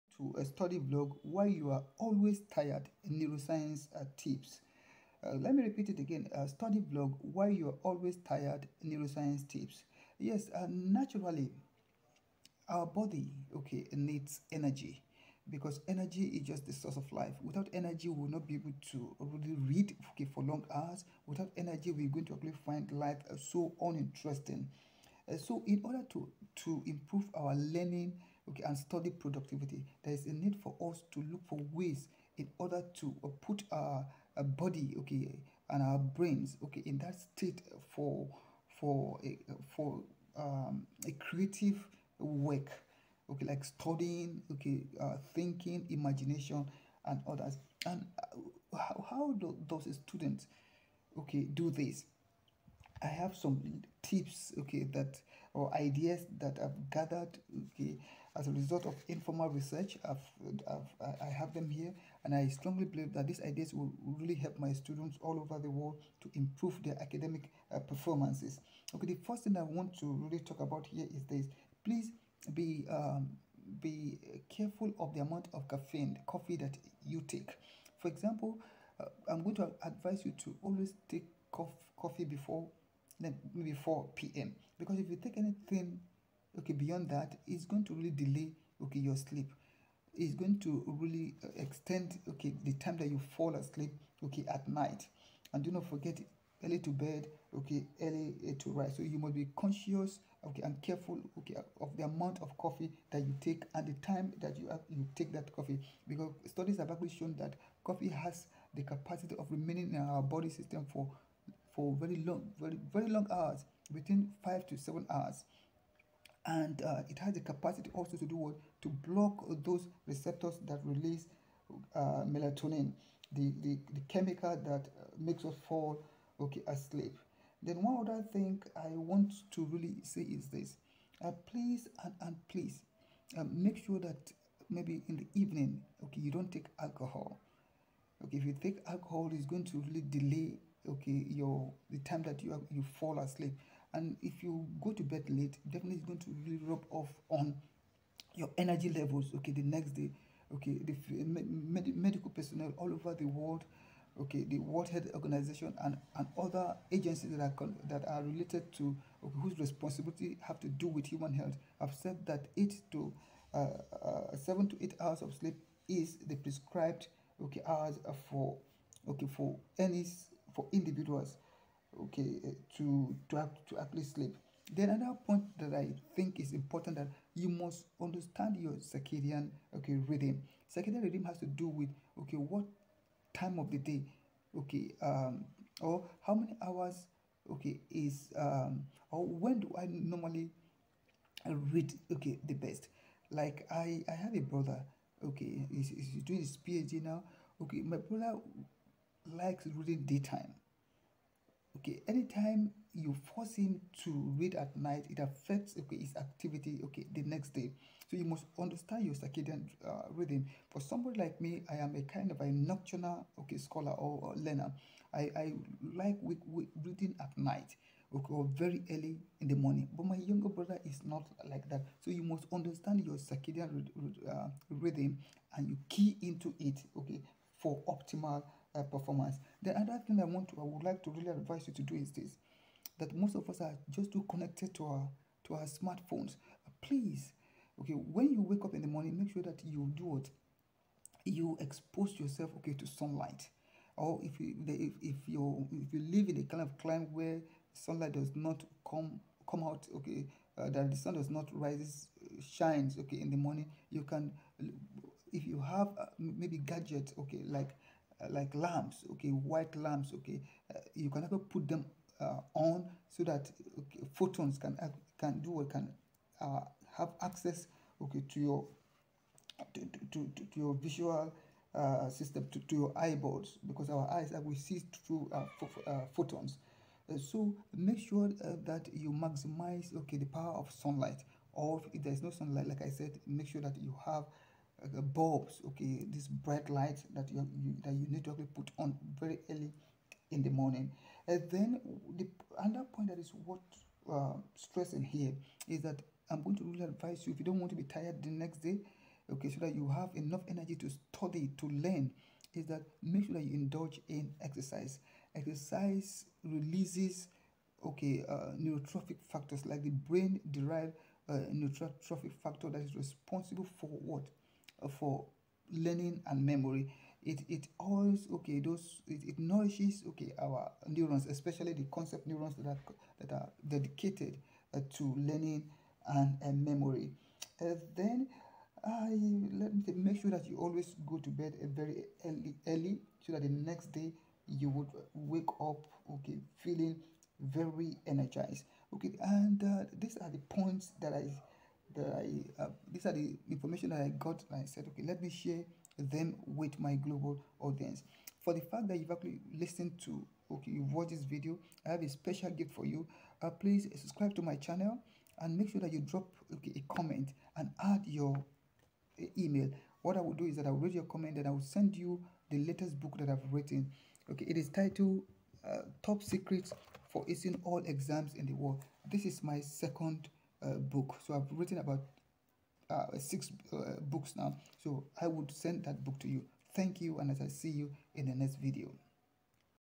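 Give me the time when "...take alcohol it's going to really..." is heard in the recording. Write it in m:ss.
2:18.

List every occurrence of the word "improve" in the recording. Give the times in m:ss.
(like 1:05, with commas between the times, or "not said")
0:26, 1:06.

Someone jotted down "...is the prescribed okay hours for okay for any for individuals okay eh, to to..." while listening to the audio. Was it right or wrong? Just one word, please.
right.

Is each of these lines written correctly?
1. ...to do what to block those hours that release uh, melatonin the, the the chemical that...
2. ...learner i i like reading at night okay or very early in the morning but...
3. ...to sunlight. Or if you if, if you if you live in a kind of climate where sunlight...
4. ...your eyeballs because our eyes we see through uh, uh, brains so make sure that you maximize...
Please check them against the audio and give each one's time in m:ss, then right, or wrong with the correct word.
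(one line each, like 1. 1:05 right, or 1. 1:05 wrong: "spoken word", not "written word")
1. 1:58 wrong: "receptors", not "hours"
2. 3:34 right
3. 4:02 right
4. 4:32 wrong: "photons", not "brains".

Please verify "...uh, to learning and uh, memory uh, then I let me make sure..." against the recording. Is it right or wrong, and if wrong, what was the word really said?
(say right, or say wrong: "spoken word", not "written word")
right.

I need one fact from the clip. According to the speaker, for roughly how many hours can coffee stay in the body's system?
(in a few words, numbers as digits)
5 to 7 hours.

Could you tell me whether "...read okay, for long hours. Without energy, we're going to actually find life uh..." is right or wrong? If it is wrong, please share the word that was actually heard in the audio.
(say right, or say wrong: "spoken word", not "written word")
right.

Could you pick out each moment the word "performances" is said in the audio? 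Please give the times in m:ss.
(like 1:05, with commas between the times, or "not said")
1:07, 3:48.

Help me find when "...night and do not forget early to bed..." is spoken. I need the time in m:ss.
1:34.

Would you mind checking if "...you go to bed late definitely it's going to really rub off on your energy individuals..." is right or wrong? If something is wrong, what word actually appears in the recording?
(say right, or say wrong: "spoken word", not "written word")
wrong: "levels", not "individuals".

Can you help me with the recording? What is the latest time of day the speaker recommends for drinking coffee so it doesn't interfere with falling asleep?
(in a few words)
4 p.m.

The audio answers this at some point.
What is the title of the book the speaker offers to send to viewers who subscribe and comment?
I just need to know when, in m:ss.
6:06.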